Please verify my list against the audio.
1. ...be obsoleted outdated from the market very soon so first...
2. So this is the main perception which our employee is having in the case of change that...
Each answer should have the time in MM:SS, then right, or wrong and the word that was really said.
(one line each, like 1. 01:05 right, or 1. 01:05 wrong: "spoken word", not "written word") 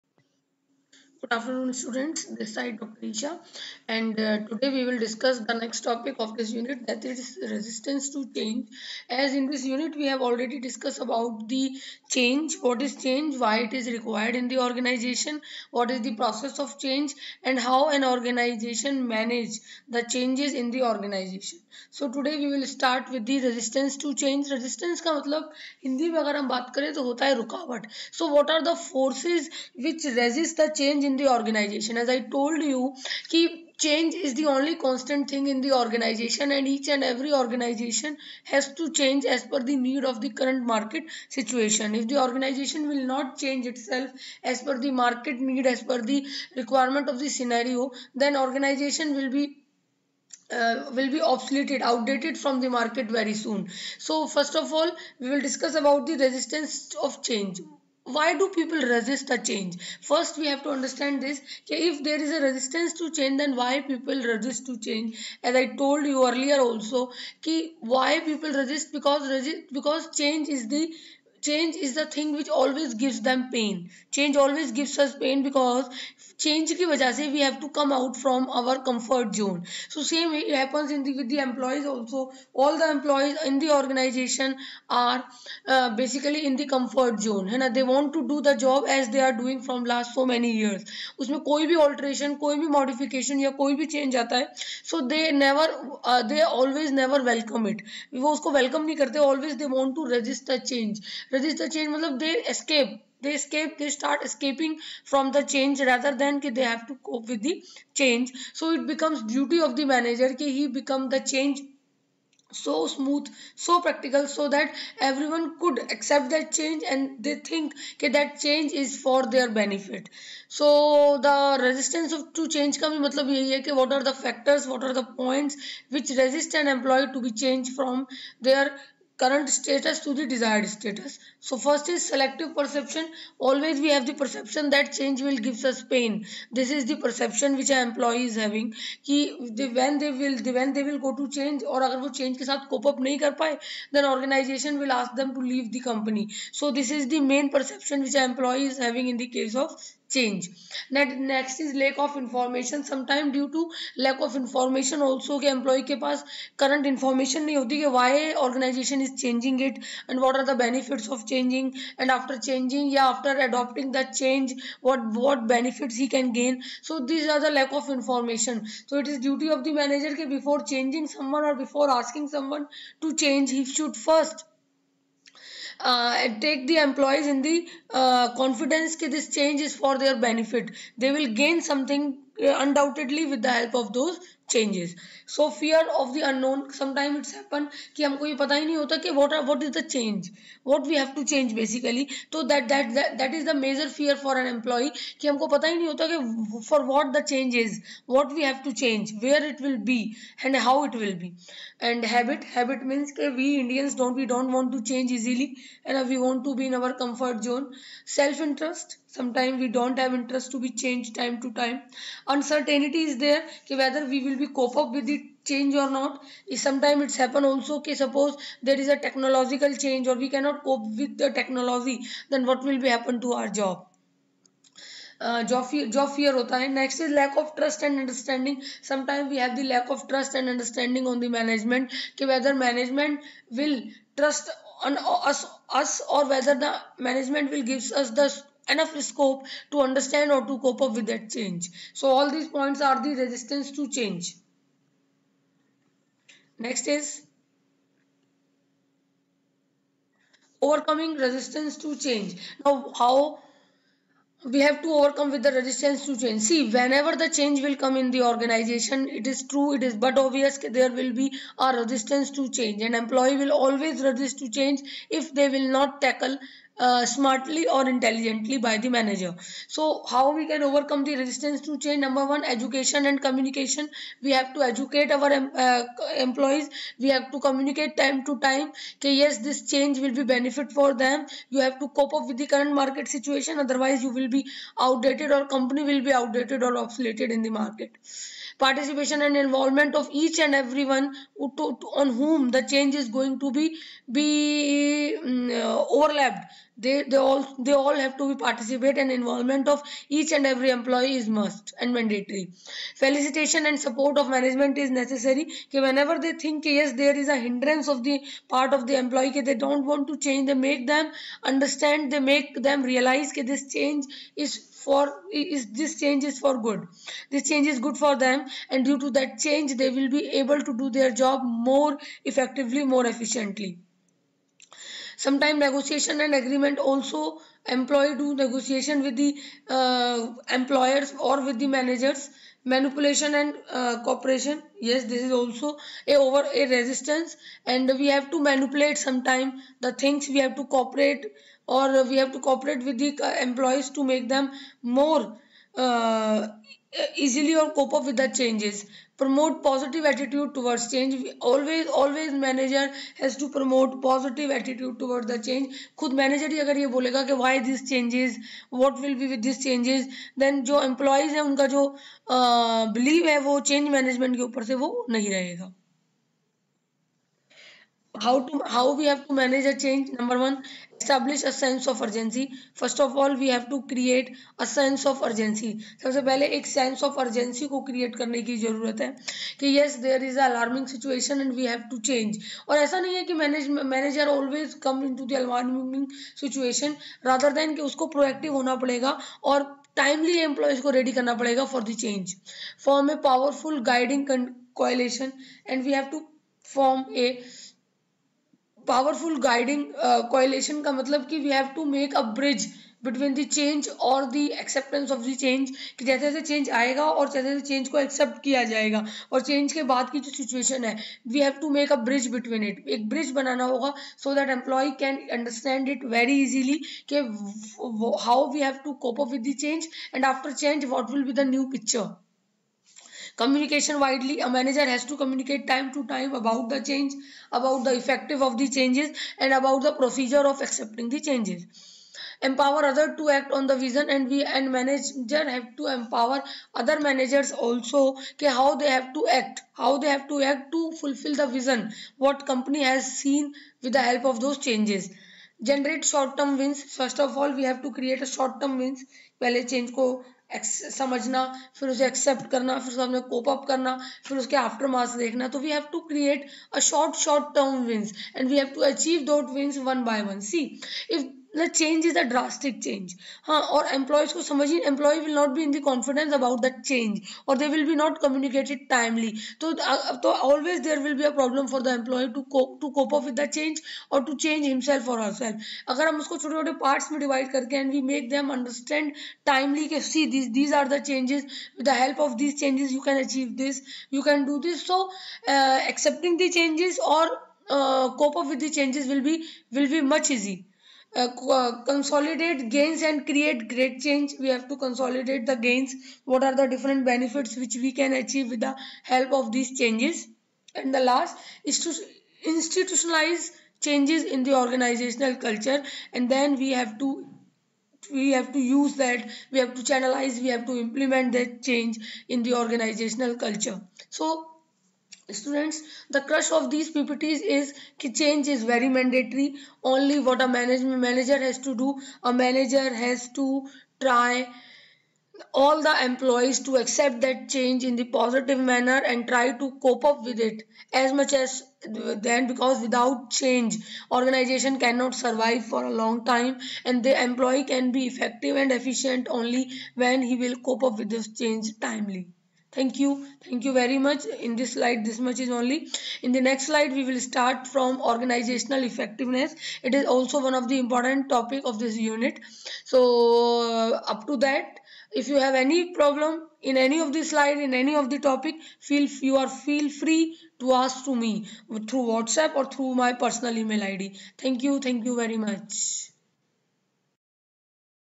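1. 00:51 right
2. 02:26 right.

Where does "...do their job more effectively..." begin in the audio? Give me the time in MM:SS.
05:20.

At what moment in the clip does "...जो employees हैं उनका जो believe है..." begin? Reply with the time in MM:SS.
06:00.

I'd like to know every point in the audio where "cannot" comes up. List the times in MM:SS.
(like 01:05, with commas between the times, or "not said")
03:40, 08:54.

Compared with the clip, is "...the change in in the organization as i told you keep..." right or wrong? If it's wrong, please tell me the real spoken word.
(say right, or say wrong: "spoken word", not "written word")
right.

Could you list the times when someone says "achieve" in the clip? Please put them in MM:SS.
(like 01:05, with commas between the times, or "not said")
08:03, 08:18.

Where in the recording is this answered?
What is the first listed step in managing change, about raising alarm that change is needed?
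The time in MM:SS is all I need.
06:11.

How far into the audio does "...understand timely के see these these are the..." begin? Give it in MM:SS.
07:58.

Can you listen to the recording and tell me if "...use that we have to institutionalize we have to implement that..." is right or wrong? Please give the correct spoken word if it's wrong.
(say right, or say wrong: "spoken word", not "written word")
wrong: "channelize", not "institutionalize".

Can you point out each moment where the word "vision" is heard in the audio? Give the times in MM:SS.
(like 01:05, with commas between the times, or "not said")
07:13, 07:21.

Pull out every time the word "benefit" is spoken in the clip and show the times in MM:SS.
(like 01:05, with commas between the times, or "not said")
01:59, 02:40, 02:45, 03:00, 04:40, 08:17.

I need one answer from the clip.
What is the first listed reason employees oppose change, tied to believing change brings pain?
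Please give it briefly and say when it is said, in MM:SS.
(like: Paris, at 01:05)
Selective perception, at 02:12.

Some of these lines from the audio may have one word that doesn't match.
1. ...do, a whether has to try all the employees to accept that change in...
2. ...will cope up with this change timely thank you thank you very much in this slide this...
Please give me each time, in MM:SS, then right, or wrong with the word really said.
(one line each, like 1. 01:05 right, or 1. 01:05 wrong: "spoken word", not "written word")
1. 08:41 wrong: "manager", not "whether"
2. 09:00 right.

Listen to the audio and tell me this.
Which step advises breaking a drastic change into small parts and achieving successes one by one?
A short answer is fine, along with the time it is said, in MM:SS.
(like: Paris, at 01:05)
Generate short-term wins, at 07:25.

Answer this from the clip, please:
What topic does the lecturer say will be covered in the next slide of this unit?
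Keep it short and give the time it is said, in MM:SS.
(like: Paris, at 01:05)
Organizational effectiveness, at 09:08.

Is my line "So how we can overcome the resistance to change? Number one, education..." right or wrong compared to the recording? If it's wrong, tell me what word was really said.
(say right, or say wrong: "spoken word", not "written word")
right.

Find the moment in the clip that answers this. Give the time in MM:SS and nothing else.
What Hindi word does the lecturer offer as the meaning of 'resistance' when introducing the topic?
00:27.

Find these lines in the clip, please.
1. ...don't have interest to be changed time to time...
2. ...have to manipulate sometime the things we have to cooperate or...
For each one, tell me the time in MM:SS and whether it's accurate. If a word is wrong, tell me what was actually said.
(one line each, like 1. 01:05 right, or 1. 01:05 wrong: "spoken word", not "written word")
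1. 03:29 right
2. 05:38 right.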